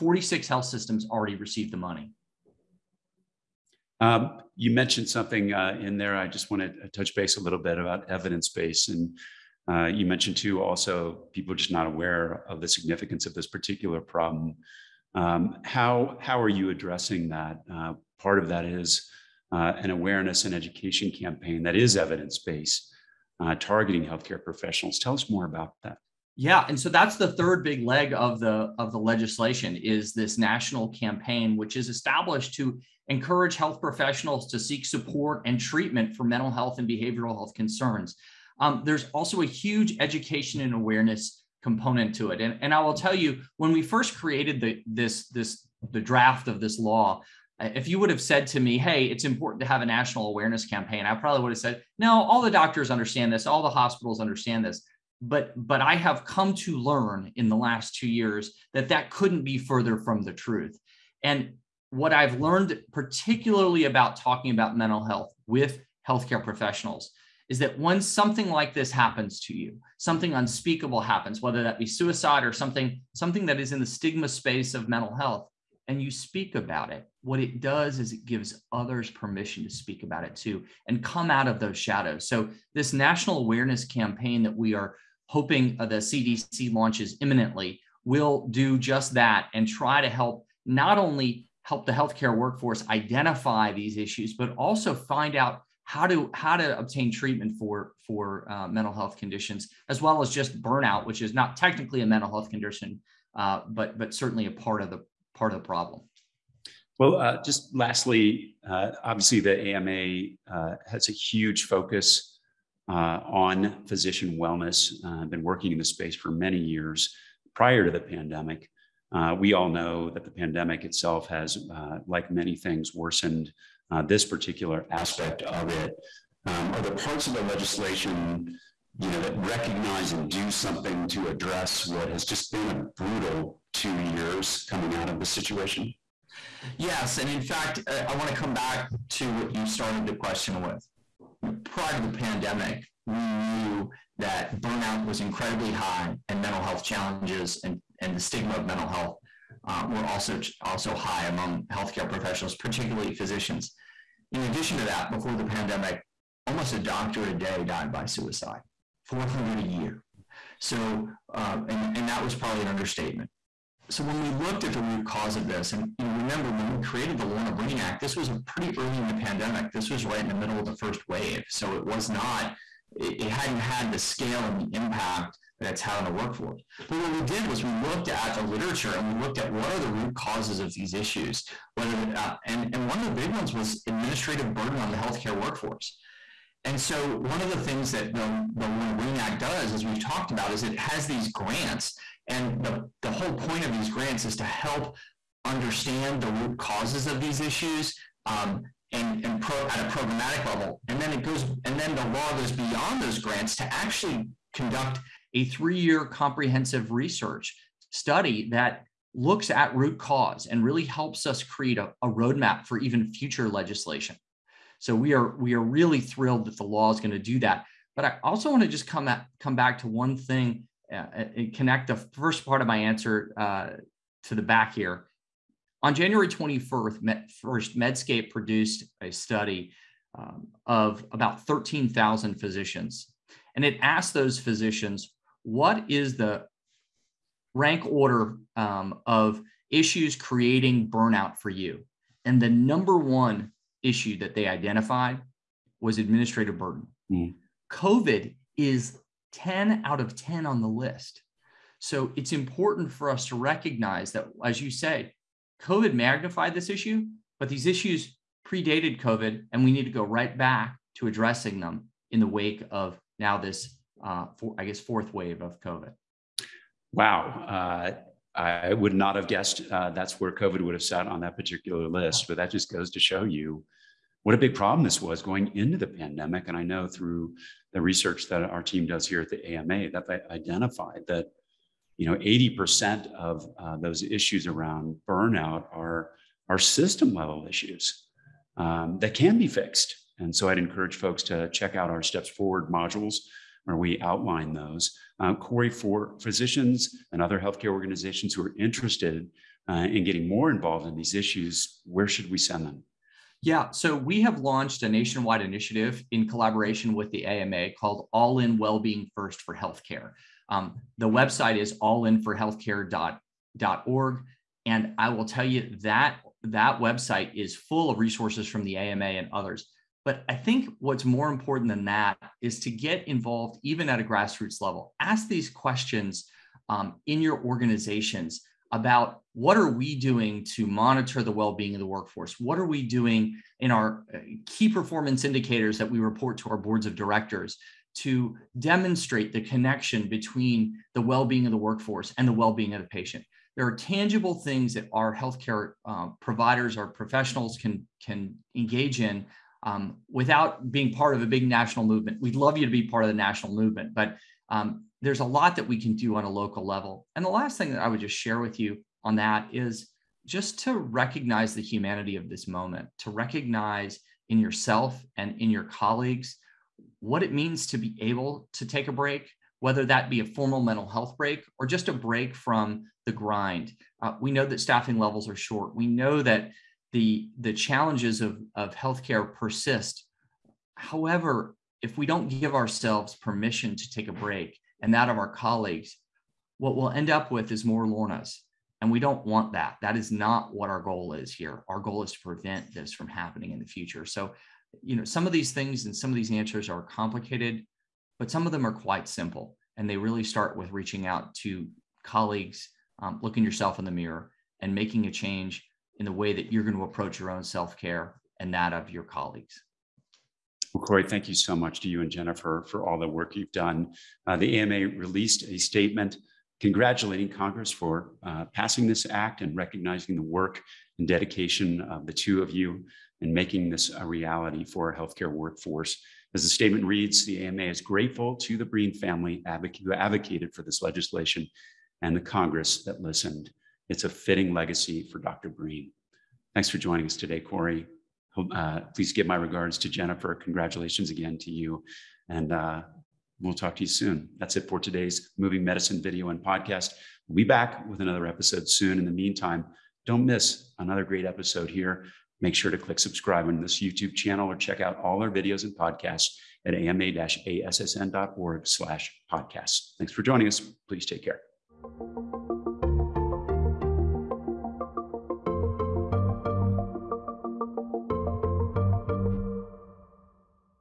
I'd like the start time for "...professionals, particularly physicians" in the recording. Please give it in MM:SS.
02:32.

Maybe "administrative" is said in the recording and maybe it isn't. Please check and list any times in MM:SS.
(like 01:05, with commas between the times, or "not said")
03:03, 04:05.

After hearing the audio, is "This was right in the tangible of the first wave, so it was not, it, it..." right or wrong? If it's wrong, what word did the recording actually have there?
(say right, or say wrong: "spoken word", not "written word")
wrong: "middle", not "tangible".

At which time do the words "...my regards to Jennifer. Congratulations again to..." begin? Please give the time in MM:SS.
07:19.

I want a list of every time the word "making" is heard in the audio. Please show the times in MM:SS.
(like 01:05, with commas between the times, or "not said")
06:44, 07:03.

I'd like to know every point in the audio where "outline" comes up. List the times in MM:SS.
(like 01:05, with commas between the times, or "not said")
04:53.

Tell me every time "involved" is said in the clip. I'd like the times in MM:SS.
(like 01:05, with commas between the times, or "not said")
05:00, 05:23.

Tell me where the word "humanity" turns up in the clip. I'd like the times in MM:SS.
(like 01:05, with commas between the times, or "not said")
06:01.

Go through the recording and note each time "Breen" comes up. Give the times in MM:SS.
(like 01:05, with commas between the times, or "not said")
02:47, 03:08, 07:08, 07:15.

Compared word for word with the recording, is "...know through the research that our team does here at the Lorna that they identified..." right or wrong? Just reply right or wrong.
wrong.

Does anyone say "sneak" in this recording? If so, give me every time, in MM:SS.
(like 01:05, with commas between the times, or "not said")
not said.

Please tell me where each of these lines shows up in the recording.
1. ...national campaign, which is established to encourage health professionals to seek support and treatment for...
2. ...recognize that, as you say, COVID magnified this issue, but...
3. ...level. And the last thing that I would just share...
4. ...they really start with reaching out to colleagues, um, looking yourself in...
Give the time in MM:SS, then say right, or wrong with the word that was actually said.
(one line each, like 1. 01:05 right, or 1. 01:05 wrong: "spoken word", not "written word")
1. 00:30 right
2. 04:13 right
3. 05:56 right
4. 06:39 right.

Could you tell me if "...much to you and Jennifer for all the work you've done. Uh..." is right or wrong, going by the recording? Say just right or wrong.
right.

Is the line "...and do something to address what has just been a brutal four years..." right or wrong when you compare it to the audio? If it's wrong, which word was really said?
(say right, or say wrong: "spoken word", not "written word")
wrong: "two", not "four".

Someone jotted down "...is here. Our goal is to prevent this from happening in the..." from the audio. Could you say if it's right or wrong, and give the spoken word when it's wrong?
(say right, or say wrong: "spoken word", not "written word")
right.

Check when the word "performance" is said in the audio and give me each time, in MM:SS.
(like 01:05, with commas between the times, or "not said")
05:34.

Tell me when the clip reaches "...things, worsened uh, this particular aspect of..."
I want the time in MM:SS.
02:02.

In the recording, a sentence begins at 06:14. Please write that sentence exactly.
Uh, we know that staffing levels are short.